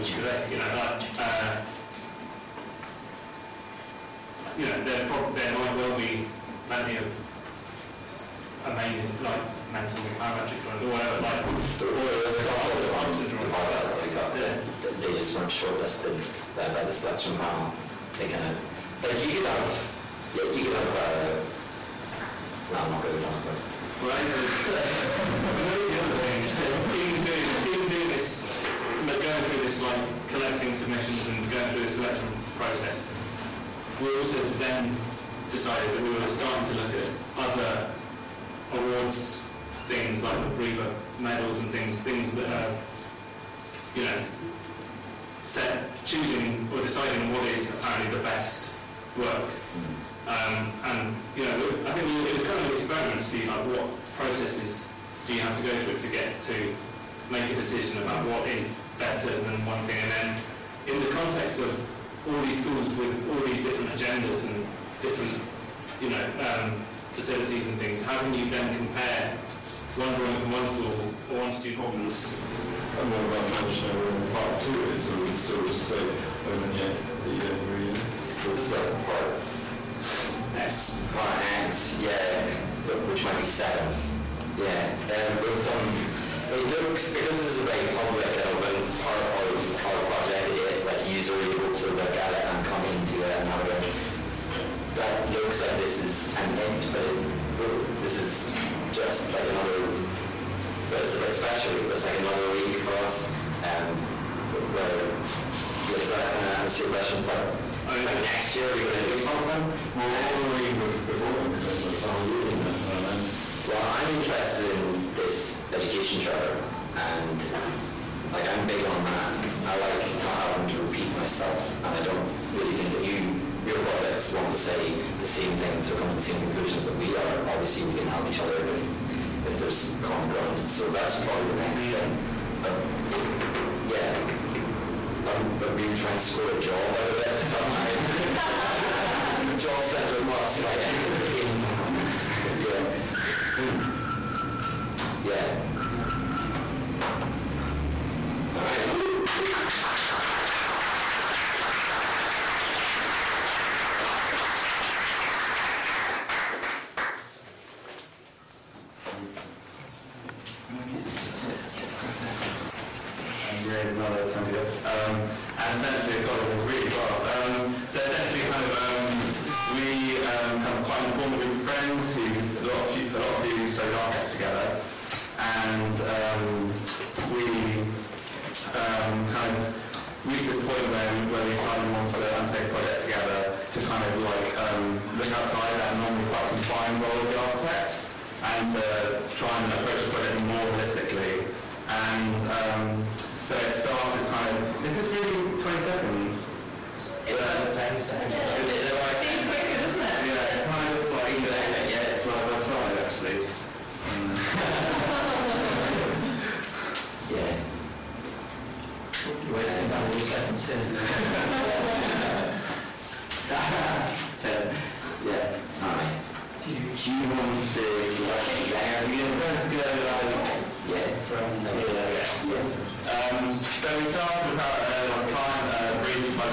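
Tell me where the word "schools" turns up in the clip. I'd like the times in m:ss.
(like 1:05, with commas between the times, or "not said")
1:02, 1:10.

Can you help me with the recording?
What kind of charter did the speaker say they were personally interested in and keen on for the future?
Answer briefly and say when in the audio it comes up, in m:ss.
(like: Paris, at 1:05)
education charter, at 1:55.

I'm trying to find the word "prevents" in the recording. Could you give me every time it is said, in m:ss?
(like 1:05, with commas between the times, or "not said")
not said.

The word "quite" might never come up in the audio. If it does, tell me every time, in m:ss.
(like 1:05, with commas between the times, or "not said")
2:50, 3:06.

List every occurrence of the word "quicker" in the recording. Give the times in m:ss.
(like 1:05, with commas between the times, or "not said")
3:19.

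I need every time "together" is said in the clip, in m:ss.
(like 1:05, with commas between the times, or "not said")
2:54, 3:03.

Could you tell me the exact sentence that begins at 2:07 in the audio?
Obviously, we can help each other if if there's common ground.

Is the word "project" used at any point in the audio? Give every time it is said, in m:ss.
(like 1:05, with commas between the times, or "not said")
1:30, 2:03, 3:02, 3:10.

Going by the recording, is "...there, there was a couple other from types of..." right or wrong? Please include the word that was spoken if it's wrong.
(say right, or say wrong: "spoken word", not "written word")
right.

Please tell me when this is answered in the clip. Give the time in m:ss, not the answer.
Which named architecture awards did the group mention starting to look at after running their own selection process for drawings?
0:40.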